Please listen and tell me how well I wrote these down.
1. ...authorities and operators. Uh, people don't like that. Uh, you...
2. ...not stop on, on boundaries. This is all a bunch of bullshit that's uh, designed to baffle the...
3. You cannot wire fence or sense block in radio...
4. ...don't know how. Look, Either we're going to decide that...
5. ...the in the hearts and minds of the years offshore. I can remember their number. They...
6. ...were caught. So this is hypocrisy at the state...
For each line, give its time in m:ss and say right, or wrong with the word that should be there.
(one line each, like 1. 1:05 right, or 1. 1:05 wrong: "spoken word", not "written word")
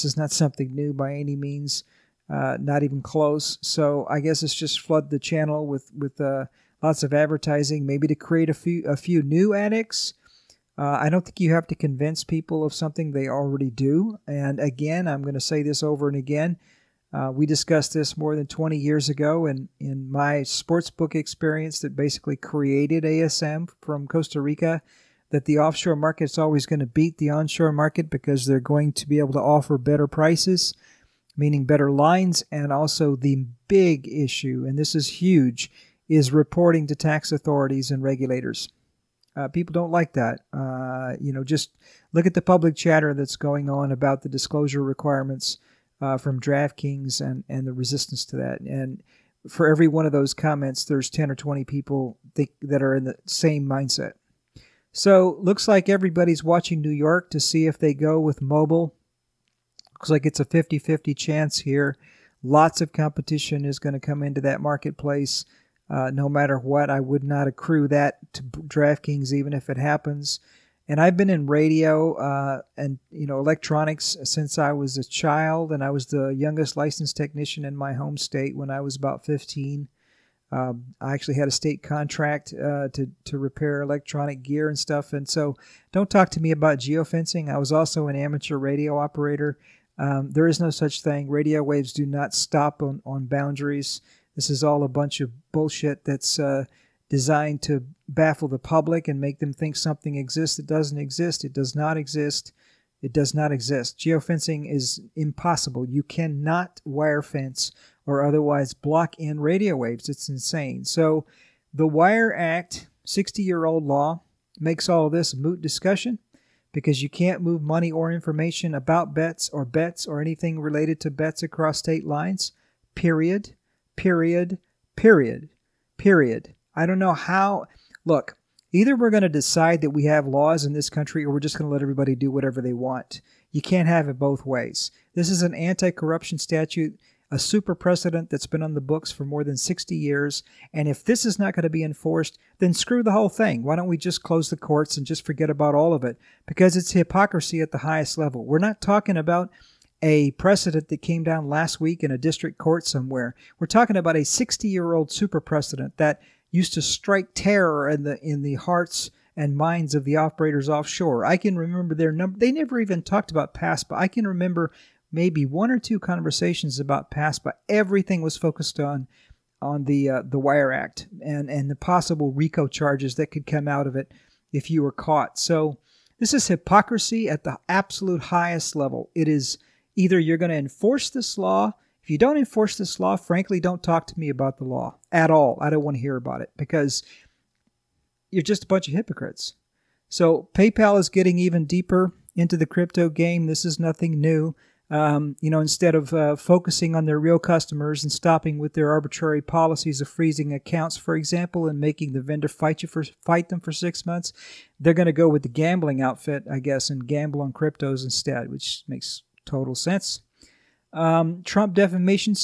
1. 0:37 wrong: "regulators", not "operators"
2. 1:32 right
3. 1:45 wrong: "otherwise", not "sense"
4. 2:06 right
5. 2:38 wrong: "operators", not "years"
6. 2:54 wrong: "absolute", not "state".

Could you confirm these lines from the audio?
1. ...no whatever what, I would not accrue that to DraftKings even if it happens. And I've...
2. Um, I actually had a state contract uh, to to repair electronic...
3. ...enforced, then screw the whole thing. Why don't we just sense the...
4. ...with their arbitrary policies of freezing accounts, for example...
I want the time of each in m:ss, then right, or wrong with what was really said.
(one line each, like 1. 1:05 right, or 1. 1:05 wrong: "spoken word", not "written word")
1. 1:06 wrong: "matter", not "whatever"
2. 1:20 right
3. 2:21 wrong: "close", not "sense"
4. 3:18 right.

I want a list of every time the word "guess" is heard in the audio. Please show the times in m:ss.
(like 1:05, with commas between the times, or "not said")
0:04, 3:26.